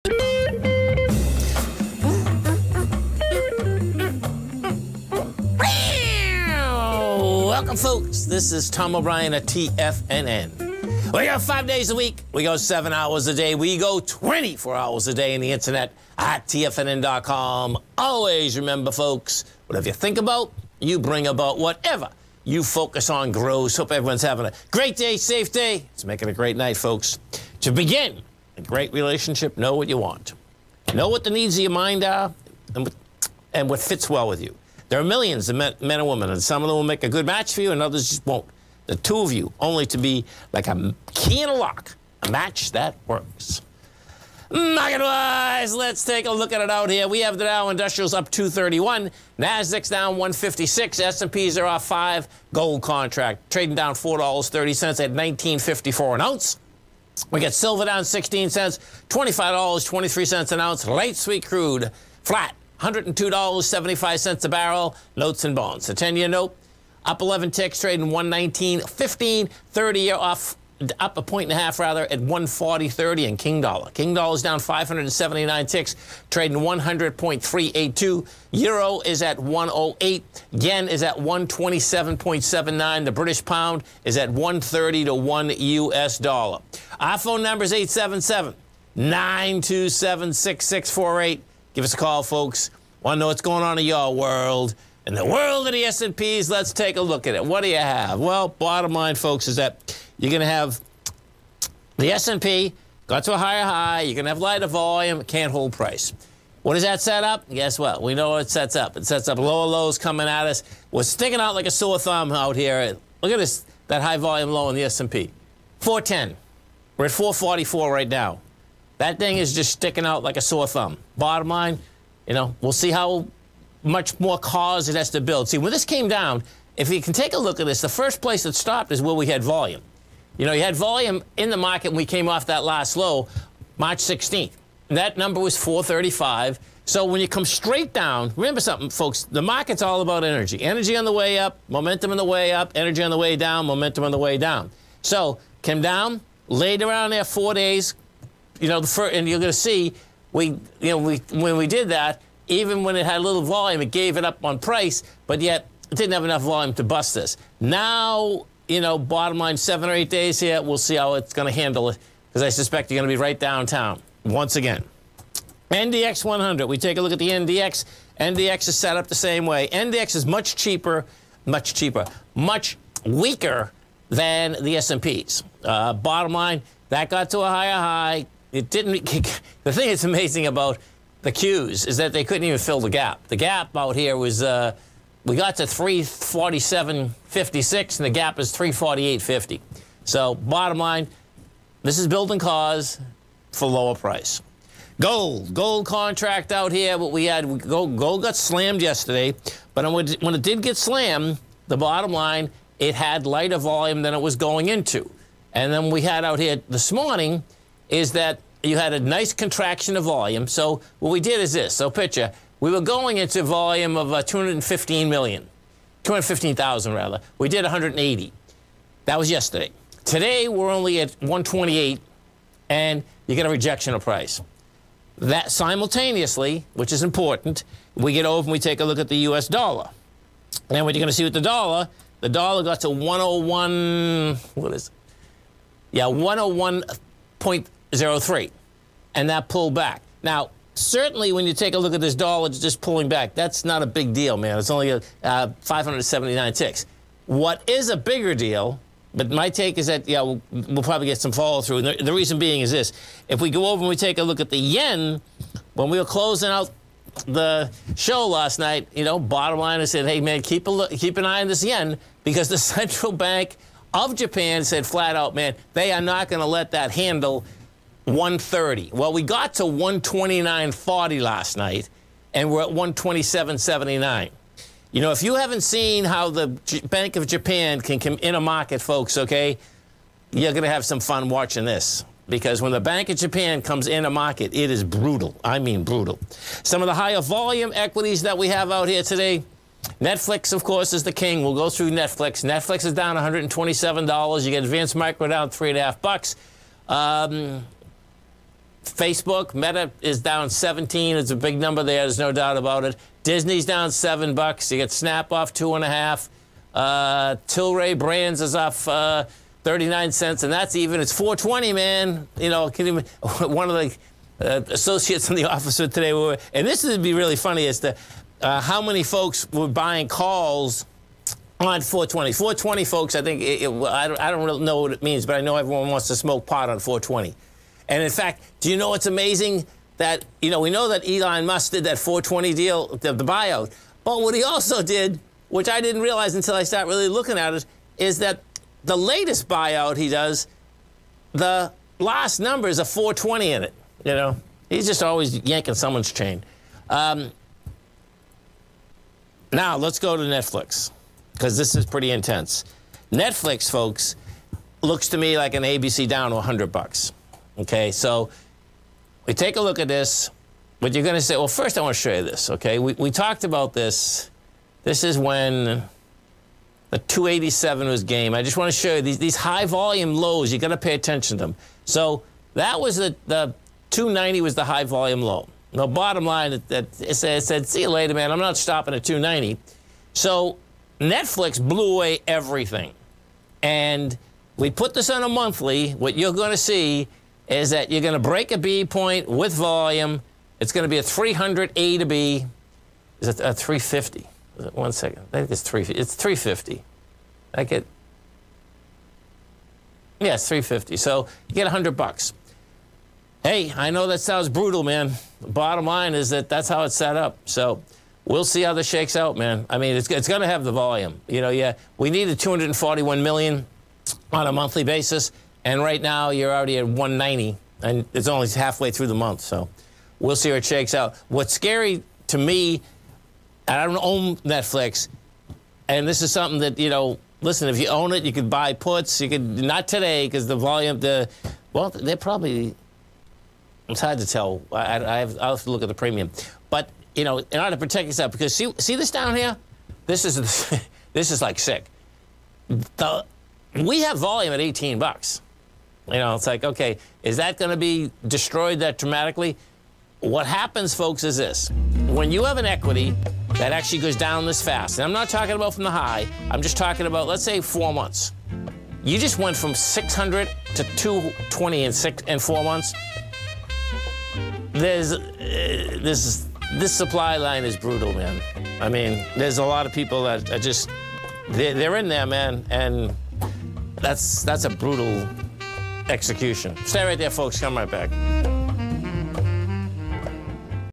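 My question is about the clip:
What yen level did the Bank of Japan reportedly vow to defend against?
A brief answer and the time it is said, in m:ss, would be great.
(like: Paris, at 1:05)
130, at 4:28.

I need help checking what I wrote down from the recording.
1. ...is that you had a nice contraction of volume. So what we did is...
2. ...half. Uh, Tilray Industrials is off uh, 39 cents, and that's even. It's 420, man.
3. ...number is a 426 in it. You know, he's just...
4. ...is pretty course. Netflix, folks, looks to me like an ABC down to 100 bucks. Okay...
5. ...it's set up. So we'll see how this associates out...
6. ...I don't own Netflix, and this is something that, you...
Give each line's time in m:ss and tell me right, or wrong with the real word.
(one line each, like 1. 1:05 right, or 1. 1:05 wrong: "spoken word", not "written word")
1. 3:27 right
2. 5:05 wrong: "Brands", not "Industrials"
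3. 5:42 wrong: "420", not "426"
4. 5:51 wrong: "intense", not "course"
5. 6:46 wrong: "shakes", not "associates"
6. 7:03 right.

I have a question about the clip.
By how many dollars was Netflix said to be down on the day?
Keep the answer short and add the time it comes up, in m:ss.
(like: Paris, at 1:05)
$127, at 4:53.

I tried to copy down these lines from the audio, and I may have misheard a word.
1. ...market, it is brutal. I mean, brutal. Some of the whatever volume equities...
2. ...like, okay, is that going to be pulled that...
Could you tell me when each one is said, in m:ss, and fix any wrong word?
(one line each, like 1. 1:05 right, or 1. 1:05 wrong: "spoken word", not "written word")
1. 4:44 wrong: "higher", not "whatever"
2. 7:26 wrong: "destroyed", not "pulled".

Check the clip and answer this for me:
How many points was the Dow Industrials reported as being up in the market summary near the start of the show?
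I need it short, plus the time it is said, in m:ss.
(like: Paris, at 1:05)
231, at 0:48.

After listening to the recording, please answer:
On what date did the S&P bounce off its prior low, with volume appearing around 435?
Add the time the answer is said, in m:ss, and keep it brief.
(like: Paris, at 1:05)
March 16th, at 2:13.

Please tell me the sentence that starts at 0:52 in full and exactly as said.
Gold contract trading down four dollars thirty cents at 19.54 an ounce.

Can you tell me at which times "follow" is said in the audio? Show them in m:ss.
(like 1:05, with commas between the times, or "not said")
4:11.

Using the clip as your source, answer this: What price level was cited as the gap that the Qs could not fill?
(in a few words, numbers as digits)
348.50.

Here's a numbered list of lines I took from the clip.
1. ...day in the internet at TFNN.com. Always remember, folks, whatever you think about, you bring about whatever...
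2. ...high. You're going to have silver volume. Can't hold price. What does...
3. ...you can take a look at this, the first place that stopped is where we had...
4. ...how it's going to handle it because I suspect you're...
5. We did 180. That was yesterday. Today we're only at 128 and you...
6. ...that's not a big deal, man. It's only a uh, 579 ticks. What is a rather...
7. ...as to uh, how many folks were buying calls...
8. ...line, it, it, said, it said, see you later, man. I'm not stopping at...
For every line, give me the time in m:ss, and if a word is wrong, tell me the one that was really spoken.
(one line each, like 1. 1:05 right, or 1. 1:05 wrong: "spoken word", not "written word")
1. 0:15 right
2. 1:43 wrong: "lighter", not "silver"
3. 2:06 right
4. 2:40 right
5. 3:37 right
6. 4:03 wrong: "bigger", not "rather"
7. 5:17 right
8. 6:16 right.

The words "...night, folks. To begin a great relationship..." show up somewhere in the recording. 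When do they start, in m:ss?
0:26.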